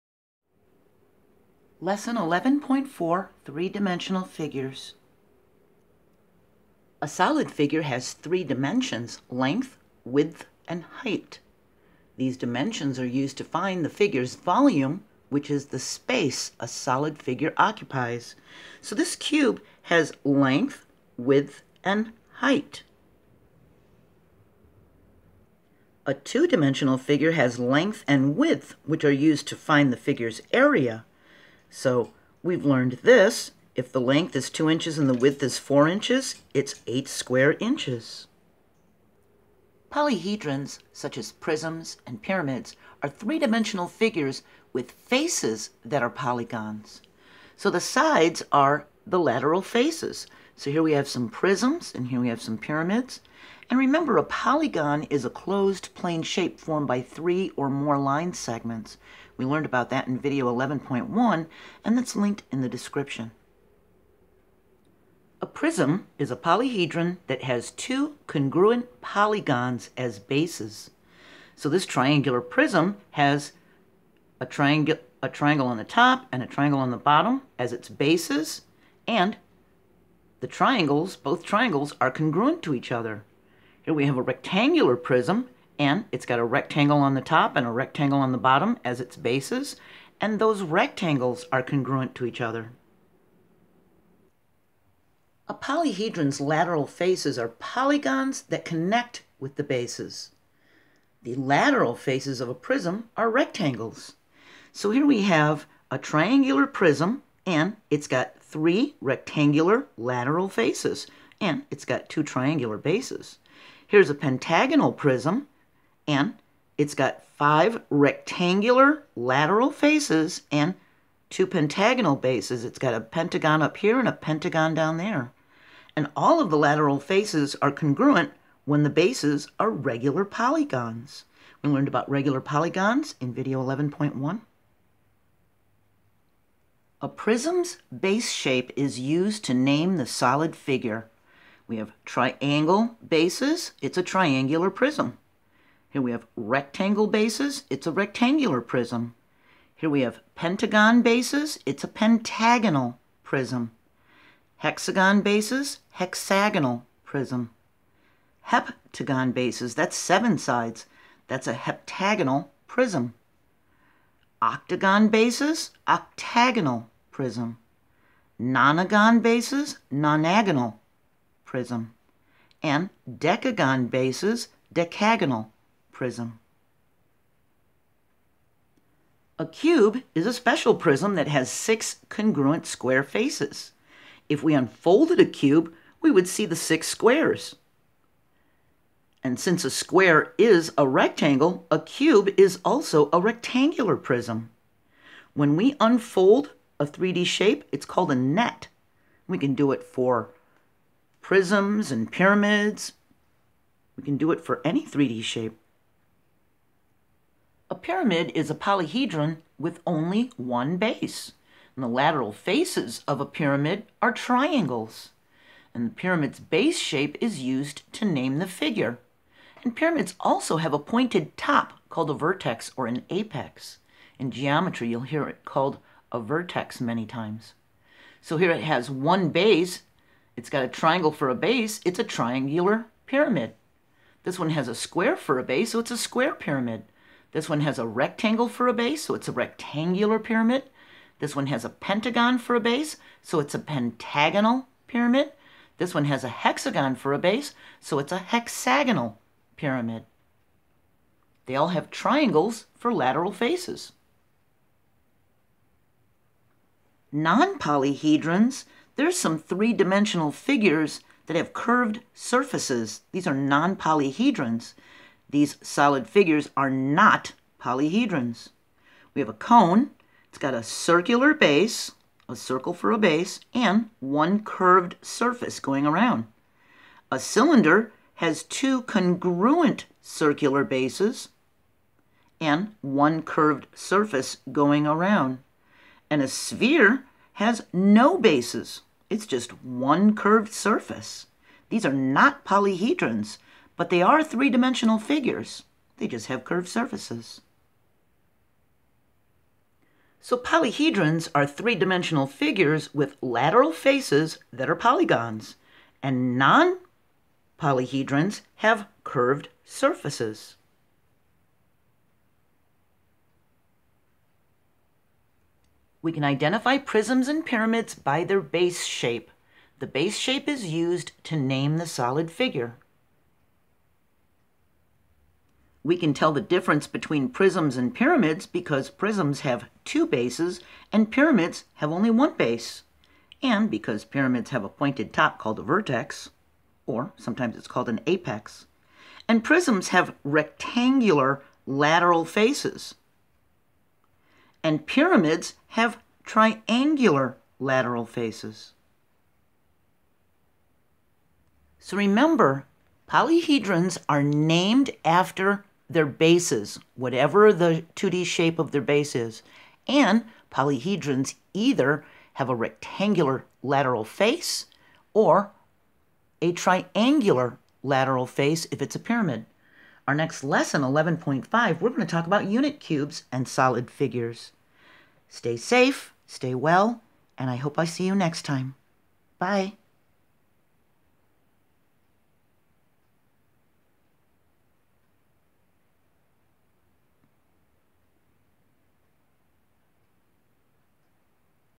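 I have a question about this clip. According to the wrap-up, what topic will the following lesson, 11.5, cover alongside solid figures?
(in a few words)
unit cubes.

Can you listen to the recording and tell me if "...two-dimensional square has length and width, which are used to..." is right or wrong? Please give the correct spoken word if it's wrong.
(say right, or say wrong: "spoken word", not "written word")
wrong: "figure", not "square".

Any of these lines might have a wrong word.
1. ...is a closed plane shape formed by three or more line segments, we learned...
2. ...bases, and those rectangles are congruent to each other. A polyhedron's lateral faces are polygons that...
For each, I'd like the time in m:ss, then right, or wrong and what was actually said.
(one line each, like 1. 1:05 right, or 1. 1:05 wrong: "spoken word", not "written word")
1. 0:55 right
2. 1:29 right.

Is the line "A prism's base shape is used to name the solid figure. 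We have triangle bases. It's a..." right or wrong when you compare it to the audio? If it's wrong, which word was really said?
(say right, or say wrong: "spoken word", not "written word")
right.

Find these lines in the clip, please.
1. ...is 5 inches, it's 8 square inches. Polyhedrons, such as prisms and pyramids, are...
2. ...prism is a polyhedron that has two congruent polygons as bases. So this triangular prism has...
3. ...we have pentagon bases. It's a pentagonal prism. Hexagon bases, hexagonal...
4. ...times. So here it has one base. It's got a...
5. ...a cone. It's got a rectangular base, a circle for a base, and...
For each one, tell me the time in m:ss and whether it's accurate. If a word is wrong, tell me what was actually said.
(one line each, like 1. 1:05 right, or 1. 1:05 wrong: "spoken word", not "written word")
1. 0:35 wrong: "4", not "5"
2. 1:05 right
3. 2:29 right
4. 3:47 right
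5. 4:29 wrong: "circular", not "rectangular".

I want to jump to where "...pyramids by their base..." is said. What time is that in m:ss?
5:17.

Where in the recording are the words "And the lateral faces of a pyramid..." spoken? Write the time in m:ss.
3:31.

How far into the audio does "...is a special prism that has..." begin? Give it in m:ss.
3:00.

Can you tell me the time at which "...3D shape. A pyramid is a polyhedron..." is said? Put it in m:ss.
3:24.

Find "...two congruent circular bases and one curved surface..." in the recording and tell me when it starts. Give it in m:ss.
4:38.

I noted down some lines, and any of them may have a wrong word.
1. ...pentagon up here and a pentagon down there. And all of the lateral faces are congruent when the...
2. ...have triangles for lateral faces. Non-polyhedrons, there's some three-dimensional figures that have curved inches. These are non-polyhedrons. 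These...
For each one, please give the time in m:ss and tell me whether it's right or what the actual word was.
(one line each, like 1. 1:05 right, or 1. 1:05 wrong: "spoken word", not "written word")
1. 2:03 right
2. 4:11 wrong: "surfaces", not "inches".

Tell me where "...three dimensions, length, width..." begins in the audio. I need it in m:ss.
0:08.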